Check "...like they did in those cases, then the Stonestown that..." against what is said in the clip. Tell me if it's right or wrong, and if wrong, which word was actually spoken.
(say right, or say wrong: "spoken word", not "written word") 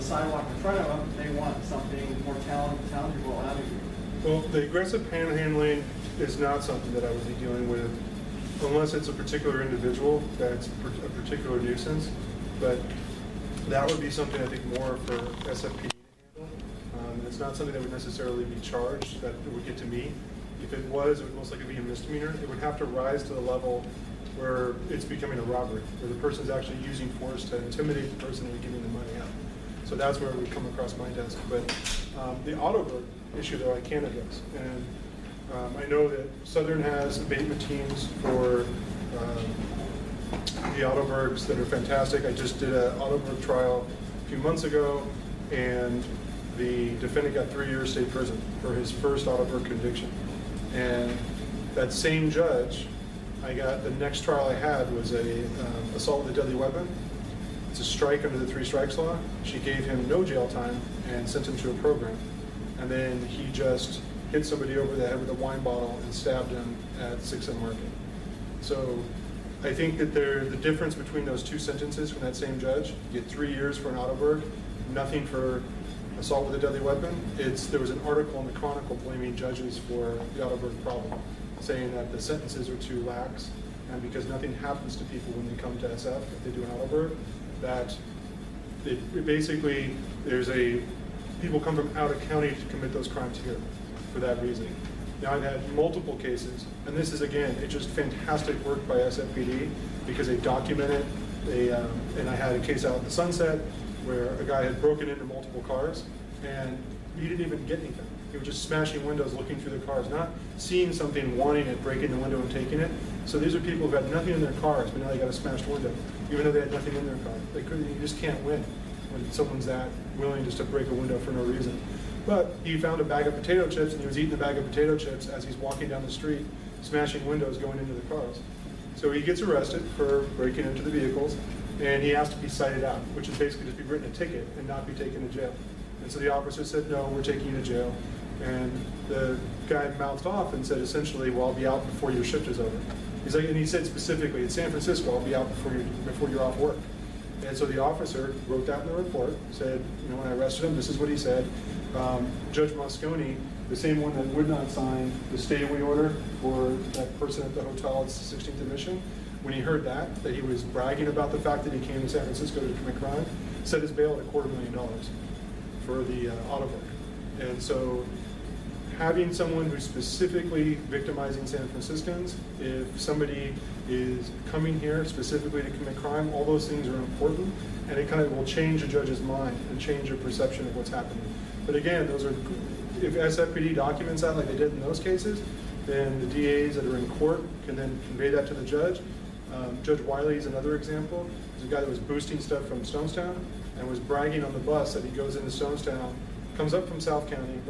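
wrong: "DAs", not "Stonestown".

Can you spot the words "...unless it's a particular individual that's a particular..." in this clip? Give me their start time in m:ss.
0:08.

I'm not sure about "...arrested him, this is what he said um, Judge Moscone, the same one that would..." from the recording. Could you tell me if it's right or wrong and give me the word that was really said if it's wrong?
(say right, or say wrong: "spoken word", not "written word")
right.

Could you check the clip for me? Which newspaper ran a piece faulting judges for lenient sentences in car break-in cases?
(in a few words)
the Chronicle.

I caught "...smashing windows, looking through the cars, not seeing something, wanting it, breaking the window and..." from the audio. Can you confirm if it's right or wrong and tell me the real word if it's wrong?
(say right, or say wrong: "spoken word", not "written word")
right.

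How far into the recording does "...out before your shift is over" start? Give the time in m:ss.
2:21.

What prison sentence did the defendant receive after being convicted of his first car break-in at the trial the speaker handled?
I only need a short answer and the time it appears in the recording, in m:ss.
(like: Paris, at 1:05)
3 years state prison, at 0:47.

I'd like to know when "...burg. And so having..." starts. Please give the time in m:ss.
2:46.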